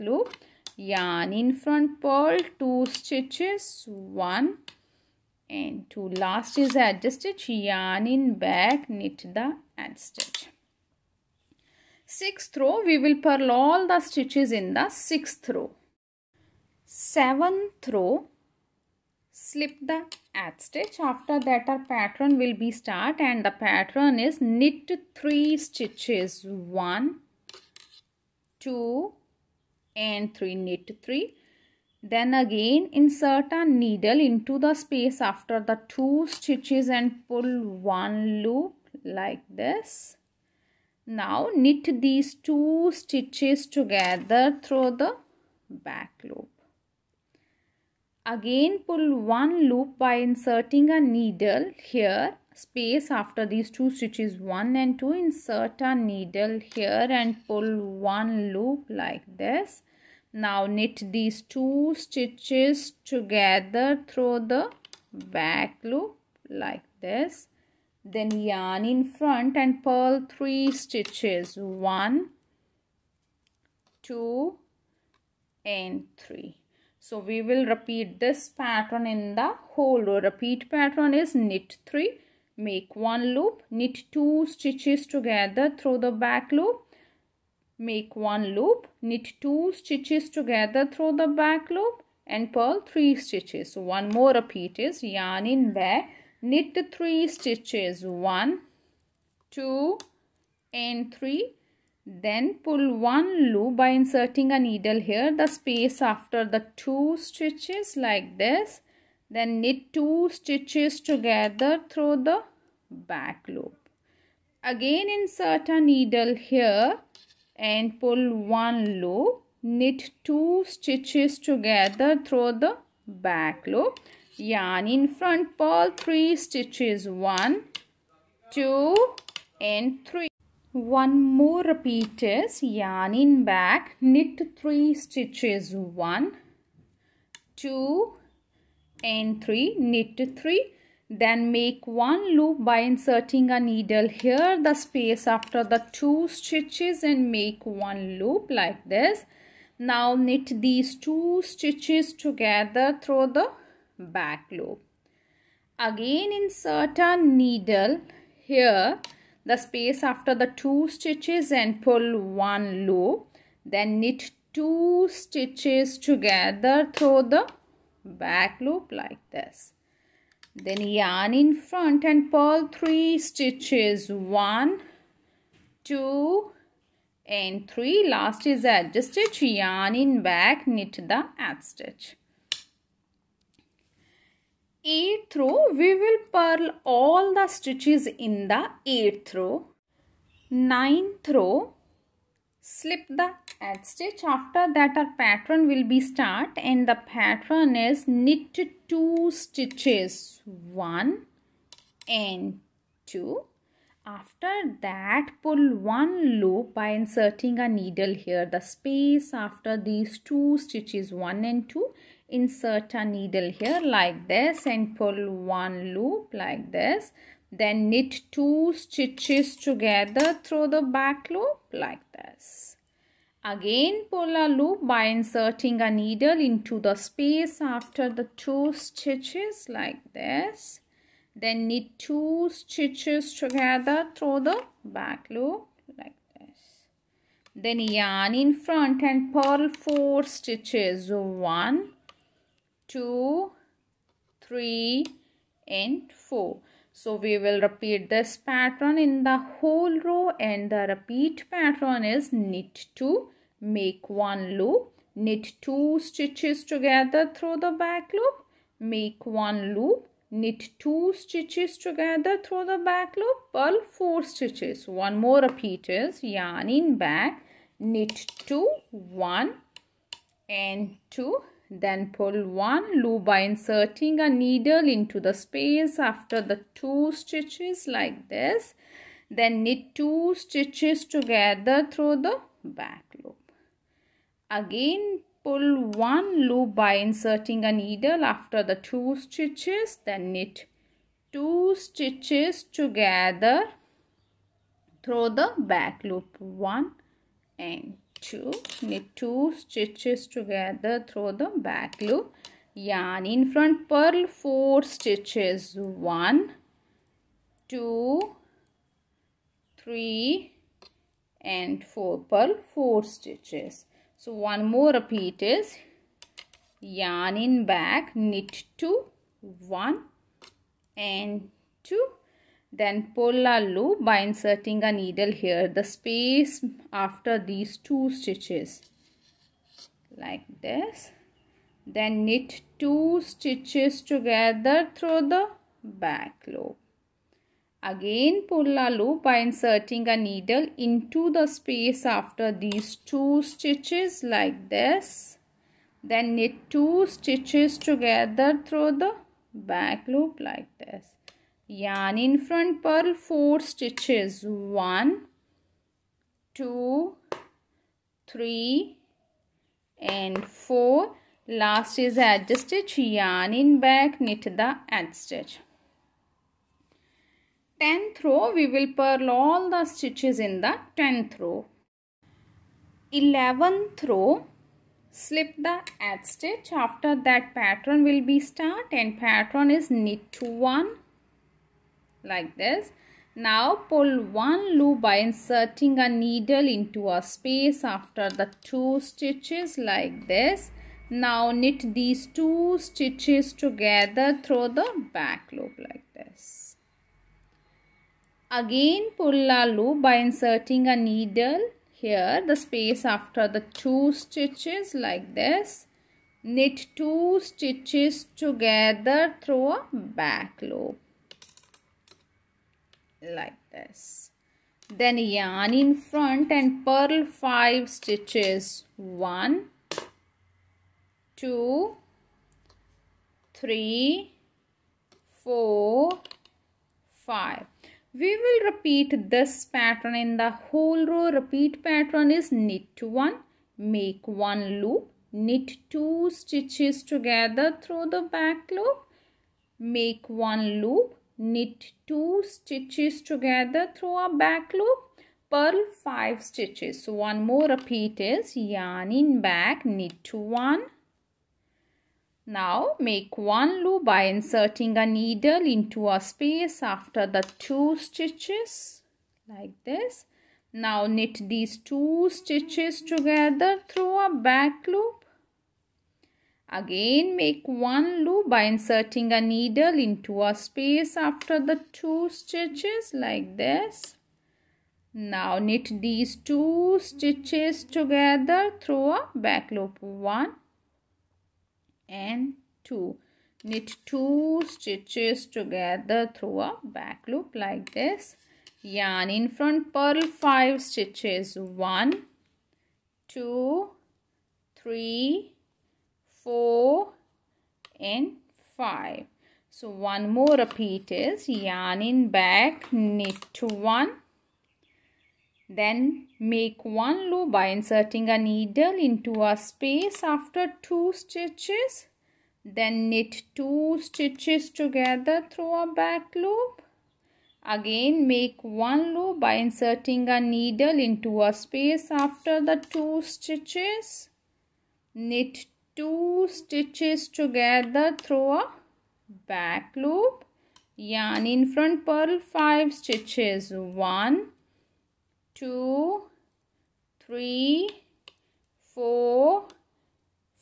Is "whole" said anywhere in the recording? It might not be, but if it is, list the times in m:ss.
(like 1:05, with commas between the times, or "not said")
1:19, 4:09, 7:10.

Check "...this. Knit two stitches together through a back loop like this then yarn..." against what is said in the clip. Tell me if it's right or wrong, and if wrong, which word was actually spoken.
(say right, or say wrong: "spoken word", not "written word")
right.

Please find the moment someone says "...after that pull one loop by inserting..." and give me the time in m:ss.
3:24.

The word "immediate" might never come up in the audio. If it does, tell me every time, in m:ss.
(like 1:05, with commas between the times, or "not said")
not said.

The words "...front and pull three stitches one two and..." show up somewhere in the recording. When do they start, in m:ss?
2:51.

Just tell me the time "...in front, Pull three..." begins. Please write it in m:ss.
2:04.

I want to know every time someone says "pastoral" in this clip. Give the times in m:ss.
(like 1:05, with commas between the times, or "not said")
not said.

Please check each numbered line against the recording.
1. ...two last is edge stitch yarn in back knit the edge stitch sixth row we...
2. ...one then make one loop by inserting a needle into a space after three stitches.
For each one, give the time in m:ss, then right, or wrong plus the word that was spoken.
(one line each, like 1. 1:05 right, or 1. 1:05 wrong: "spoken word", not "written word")
1. 0:05 right
2. 8:23 wrong: "two", not "three".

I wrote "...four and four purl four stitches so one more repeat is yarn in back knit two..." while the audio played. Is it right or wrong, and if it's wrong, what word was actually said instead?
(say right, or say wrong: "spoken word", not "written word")
wrong: "three", not "four".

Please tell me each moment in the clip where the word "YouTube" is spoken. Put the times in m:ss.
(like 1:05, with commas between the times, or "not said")
not said.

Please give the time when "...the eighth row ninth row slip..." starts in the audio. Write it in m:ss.
3:08.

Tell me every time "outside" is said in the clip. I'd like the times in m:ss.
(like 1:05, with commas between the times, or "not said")
not said.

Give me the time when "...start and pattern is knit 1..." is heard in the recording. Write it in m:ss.
6:18.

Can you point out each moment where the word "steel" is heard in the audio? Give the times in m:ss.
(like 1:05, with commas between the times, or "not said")
not said.